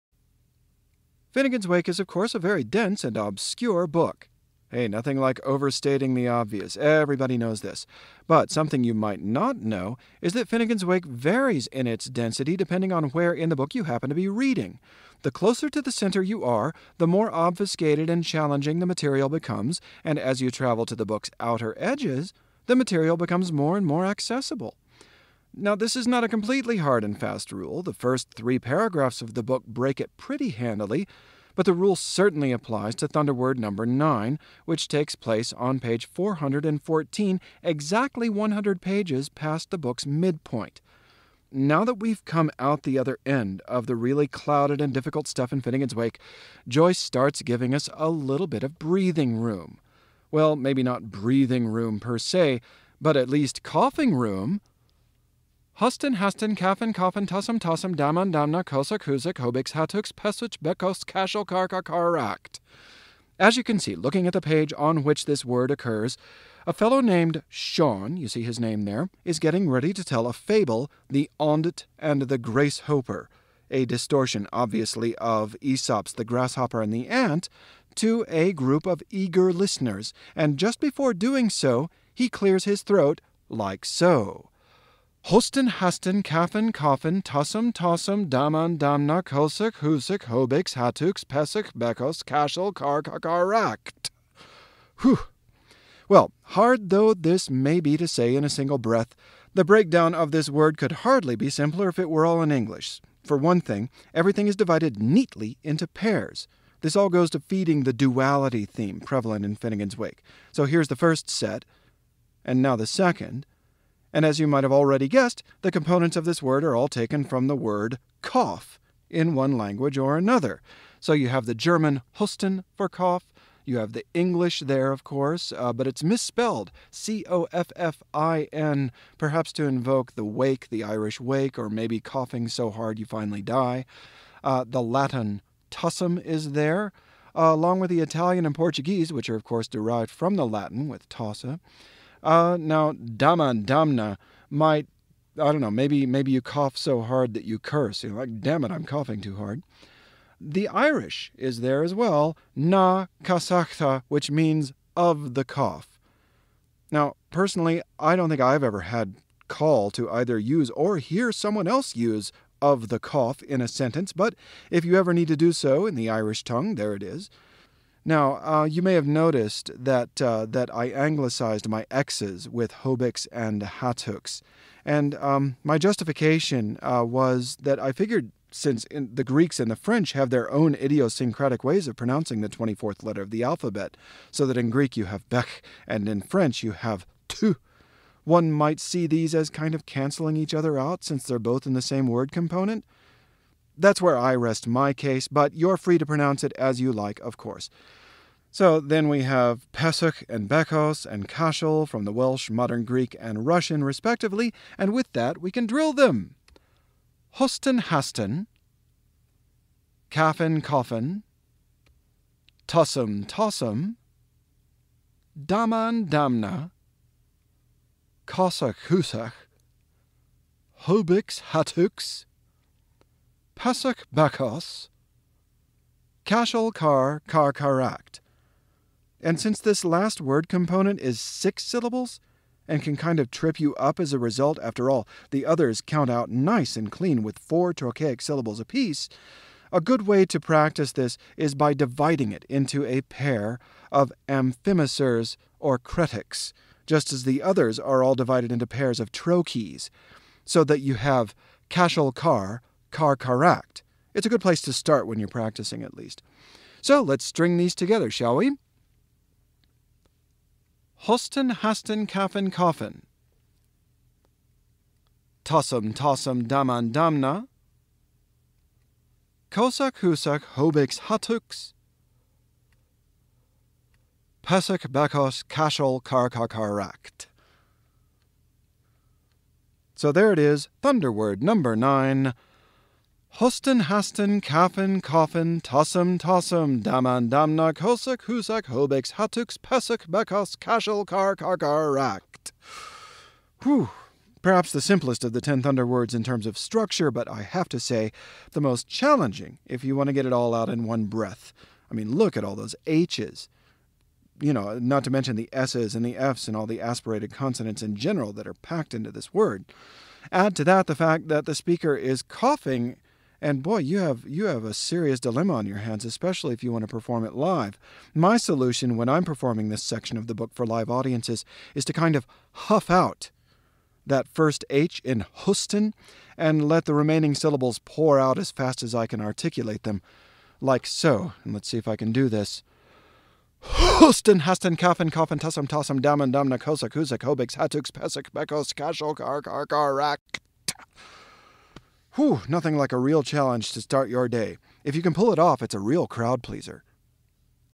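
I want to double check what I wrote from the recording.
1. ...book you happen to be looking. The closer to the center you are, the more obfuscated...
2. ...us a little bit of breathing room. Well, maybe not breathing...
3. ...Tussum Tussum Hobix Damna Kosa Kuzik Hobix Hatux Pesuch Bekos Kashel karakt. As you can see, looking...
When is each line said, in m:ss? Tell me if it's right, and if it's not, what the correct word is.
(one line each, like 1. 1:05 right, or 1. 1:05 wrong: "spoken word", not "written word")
1. 0:13 wrong: "reading", not "looking"
2. 0:47 right
3. 0:57 wrong: "Daman", not "Hobix".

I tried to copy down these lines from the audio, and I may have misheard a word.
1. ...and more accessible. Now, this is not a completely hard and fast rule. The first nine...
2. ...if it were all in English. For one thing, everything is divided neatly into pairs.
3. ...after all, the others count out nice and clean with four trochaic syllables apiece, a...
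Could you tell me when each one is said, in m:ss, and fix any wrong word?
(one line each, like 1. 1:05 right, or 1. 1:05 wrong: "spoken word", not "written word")
1. 0:23 wrong: "three", not "nine"
2. 1:41 right
3. 3:54 right.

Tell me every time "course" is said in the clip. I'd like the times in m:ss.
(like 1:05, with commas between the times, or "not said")
0:02, 2:05, 2:19, 3:17.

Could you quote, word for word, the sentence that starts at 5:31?
And let's see if I can do this.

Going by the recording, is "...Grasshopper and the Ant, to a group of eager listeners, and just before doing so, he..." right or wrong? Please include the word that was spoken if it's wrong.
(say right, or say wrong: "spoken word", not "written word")
right.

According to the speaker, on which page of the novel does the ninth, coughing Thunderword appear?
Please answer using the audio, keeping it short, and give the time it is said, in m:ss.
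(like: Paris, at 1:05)
414, at 0:35.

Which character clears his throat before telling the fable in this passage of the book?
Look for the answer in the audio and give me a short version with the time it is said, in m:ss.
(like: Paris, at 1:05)
Sean, at 1:07.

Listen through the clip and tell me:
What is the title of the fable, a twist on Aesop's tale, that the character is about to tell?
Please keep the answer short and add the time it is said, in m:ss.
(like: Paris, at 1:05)
The Ondit and the Gracehoper, at 1:11.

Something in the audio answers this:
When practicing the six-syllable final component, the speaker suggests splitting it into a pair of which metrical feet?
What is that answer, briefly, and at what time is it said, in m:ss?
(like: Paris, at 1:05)
amphimacers or cretics, at 4:04.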